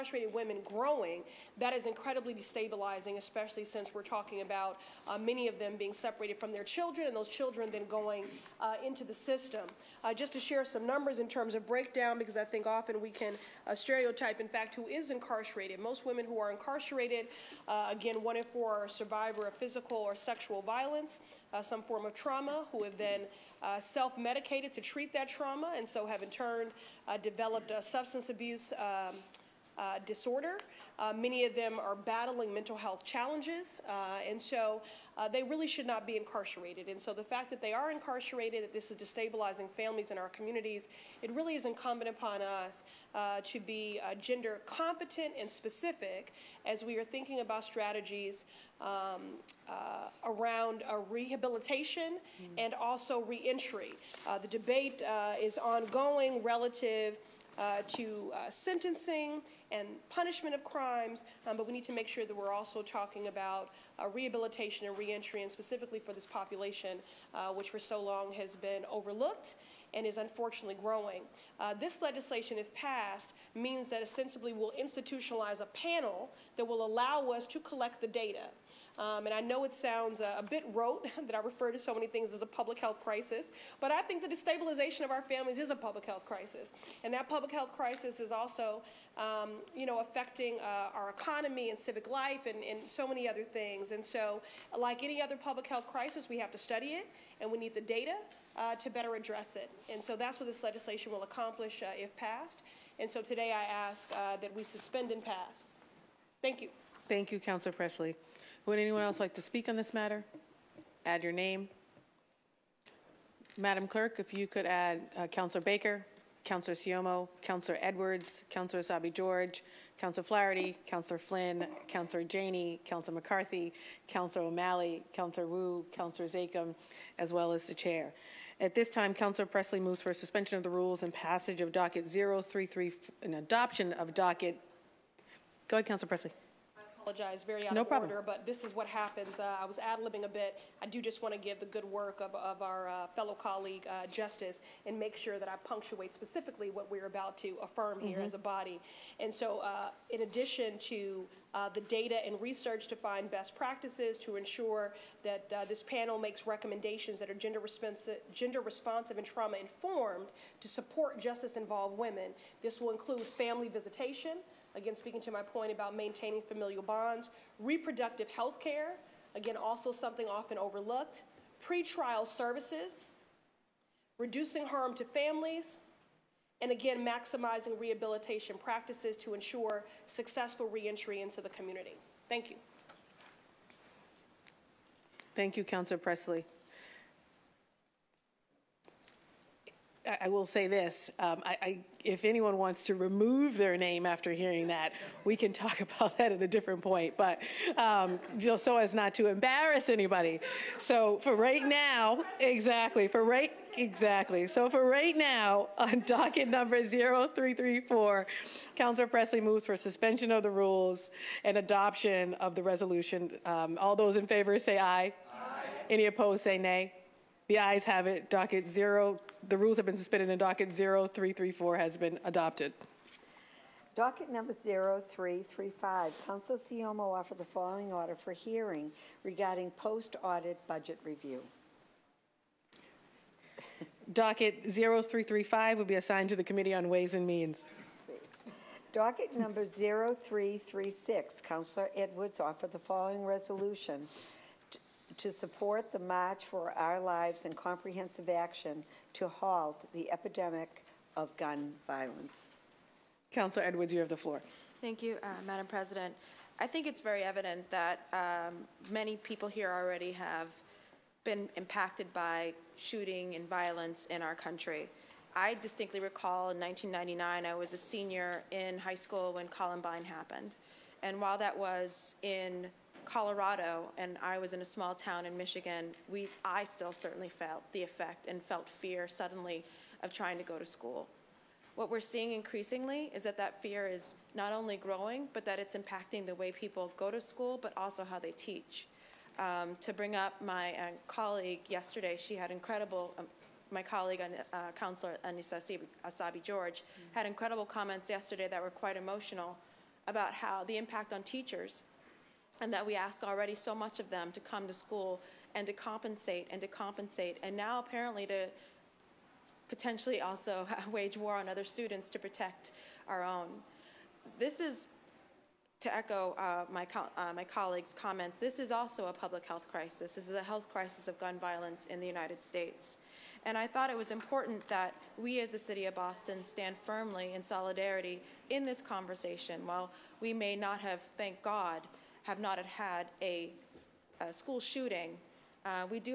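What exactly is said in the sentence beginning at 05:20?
This is a health crisis of gun violence in the United States.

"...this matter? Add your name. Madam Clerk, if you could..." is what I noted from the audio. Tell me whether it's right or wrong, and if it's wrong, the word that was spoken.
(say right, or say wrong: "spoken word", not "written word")
right.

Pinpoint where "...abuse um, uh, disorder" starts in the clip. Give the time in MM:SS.
00:28.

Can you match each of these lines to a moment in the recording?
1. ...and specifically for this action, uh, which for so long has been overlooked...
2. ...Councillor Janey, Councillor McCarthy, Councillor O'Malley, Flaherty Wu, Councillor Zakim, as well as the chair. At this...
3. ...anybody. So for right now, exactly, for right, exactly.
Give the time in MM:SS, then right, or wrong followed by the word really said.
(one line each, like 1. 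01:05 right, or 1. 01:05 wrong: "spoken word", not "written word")
1. 01:05 wrong: "population", not "action"
2. 02:01 wrong: "Councillor", not "Flaherty"
3. 03:19 right.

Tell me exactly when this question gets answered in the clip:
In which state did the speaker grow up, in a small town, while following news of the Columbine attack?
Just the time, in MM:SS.
04:35.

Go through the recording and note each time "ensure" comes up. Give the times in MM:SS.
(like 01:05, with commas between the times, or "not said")
02:34, 02:59.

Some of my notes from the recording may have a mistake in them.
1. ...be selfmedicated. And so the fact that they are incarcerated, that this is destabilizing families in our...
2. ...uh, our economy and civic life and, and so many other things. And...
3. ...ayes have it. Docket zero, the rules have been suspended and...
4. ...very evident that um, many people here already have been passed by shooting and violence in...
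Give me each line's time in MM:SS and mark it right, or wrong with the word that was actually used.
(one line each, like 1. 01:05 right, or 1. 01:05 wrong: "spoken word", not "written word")
1. 00:36 wrong: "incarcerated", not "selfmedicated"
2. 01:30 right
3. 03:37 right
4. 04:17 wrong: "impacted", not "passed".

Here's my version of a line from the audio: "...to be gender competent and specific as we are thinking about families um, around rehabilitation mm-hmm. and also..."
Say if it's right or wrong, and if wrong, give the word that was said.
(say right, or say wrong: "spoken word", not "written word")
wrong: "strategies", not "families".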